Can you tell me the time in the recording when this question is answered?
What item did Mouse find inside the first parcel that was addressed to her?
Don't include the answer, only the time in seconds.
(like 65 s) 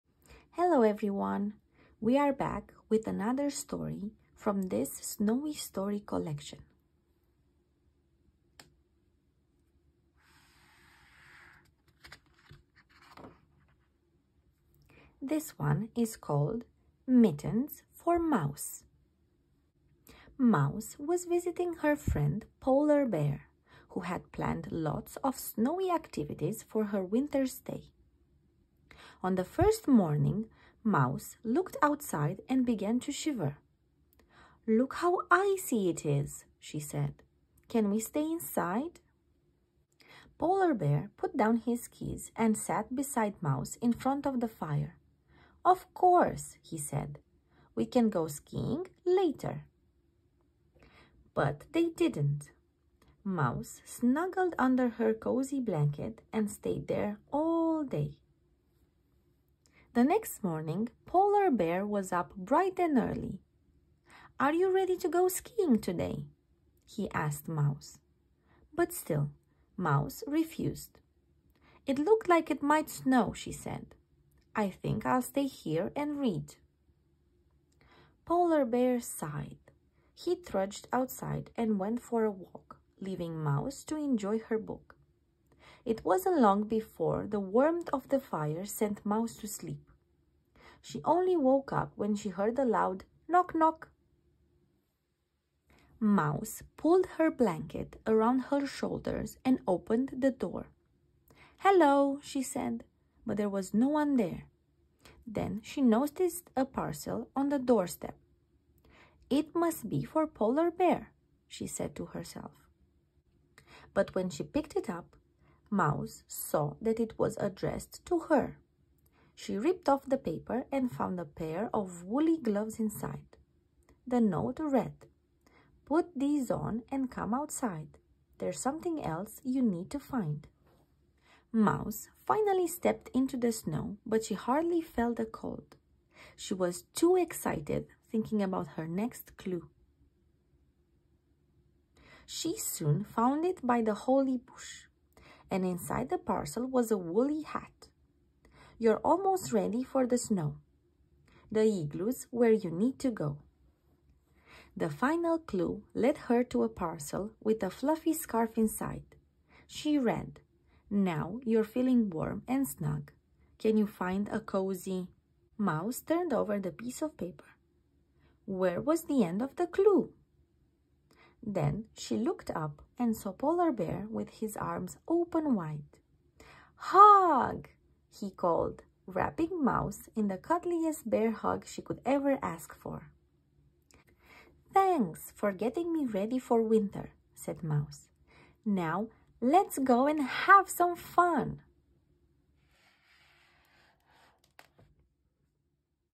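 122 s.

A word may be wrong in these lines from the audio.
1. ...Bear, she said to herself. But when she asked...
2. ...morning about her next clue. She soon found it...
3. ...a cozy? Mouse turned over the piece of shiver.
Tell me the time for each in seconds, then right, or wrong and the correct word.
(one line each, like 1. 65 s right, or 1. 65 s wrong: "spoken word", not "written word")
1. 110 s wrong: "picked", not "asked"
2. 138 s wrong: "thinking", not "morning"
3. 164 s wrong: "paper", not "shiver".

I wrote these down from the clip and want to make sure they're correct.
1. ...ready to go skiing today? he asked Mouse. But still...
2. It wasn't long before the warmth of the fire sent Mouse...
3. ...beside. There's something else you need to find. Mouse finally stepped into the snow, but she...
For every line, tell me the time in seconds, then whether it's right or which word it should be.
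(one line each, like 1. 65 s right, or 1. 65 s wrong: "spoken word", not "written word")
1. 64 s right
2. 85 s right
3. 127 s wrong: "outside", not "beside".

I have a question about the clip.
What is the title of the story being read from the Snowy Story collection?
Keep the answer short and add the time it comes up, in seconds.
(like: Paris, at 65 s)
Mittens for Mouse, at 17 s.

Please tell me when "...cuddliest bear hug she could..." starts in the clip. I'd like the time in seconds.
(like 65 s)
180 s.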